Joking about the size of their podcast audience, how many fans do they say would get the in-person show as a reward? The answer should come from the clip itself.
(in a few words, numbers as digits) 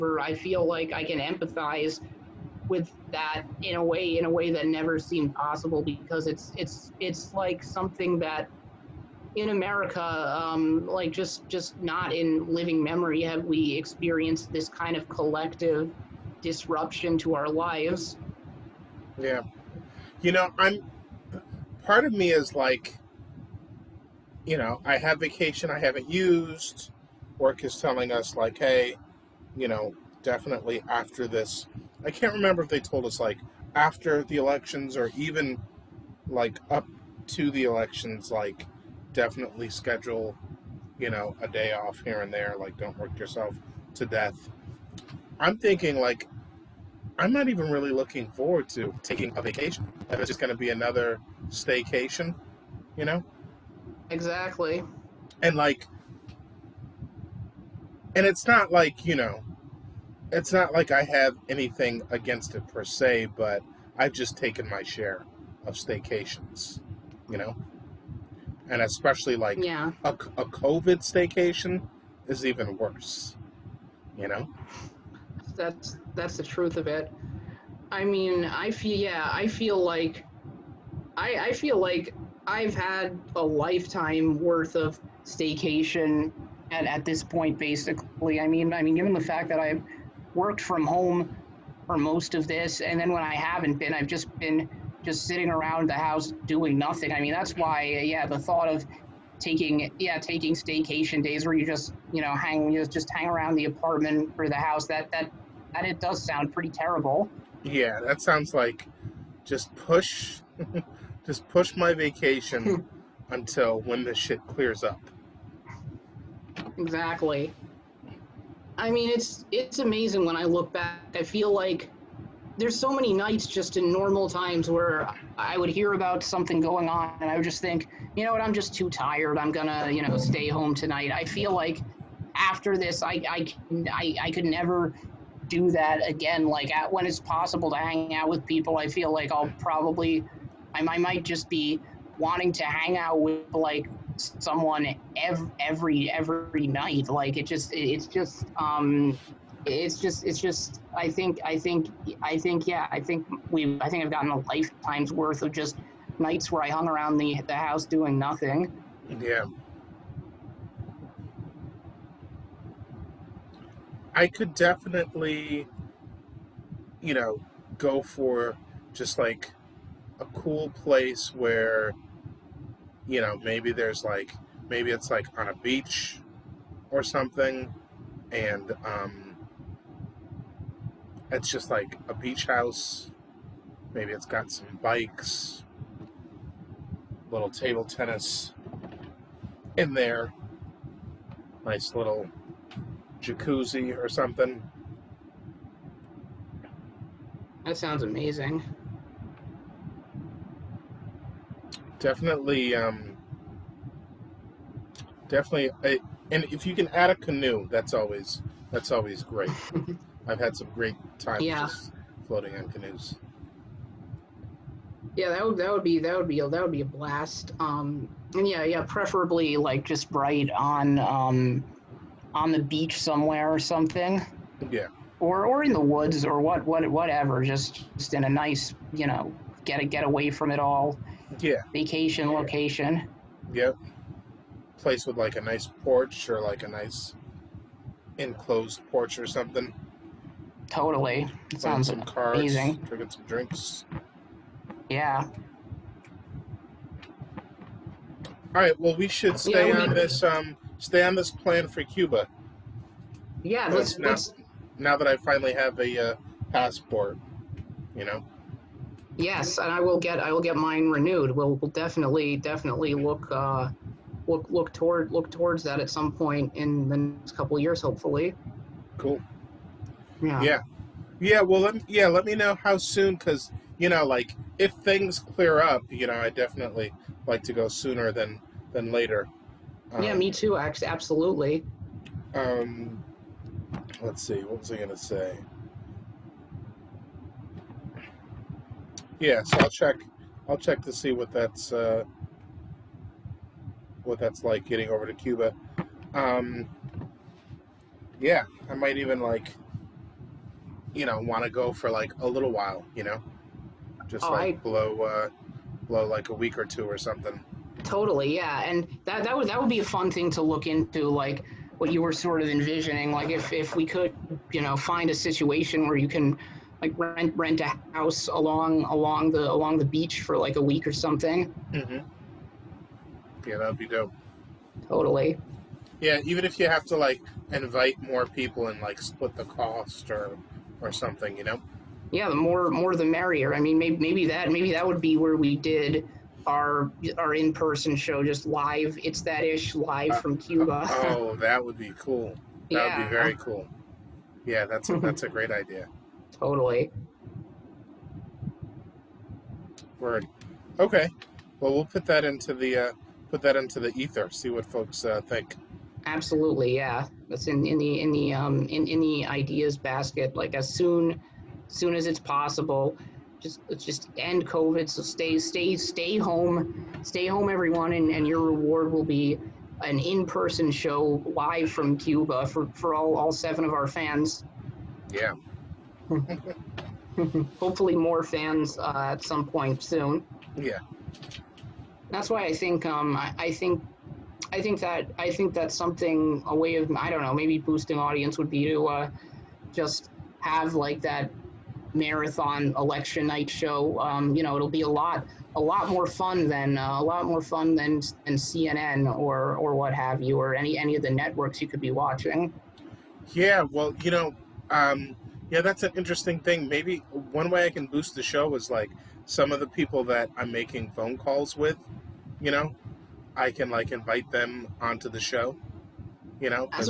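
7.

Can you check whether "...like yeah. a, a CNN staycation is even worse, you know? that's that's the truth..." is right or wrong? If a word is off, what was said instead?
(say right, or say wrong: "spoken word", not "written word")
wrong: "COVID", not "CNN".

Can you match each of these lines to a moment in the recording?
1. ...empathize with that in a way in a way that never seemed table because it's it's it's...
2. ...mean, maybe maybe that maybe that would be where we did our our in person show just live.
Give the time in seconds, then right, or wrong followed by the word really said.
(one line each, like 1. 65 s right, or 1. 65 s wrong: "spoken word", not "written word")
1. 1 s wrong: "possible", not "table"
2. 333 s right.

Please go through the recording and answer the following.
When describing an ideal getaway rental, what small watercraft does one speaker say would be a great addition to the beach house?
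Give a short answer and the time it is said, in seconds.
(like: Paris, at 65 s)
canoe, at 207 s.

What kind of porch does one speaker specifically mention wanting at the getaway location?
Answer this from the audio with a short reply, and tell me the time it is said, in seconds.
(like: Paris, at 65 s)
enclosed porch, at 238 s.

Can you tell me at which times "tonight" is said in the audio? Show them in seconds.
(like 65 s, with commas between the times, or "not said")
130 s.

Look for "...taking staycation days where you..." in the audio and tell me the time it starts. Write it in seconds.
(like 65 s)
100 s.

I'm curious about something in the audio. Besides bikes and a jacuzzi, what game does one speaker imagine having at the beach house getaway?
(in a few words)
table tennis.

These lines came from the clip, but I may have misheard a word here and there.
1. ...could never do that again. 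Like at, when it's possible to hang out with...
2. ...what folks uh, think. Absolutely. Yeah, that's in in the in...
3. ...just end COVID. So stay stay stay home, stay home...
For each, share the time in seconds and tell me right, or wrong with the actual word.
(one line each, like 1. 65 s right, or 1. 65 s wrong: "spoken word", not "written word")
1. 134 s right
2. 354 s right
3. 363 s right.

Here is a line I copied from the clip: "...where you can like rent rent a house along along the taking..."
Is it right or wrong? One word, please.
wrong.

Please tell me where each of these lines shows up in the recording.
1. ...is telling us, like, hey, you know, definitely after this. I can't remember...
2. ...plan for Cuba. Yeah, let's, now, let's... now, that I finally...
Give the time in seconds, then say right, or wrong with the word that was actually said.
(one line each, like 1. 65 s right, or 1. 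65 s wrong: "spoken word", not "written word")
1. 27 s right
2. 251 s right.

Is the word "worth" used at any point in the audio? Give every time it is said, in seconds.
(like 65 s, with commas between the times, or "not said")
84 s, 155 s.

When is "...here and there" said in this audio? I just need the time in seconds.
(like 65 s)
42 s.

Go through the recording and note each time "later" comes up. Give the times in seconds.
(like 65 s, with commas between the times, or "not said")
278 s.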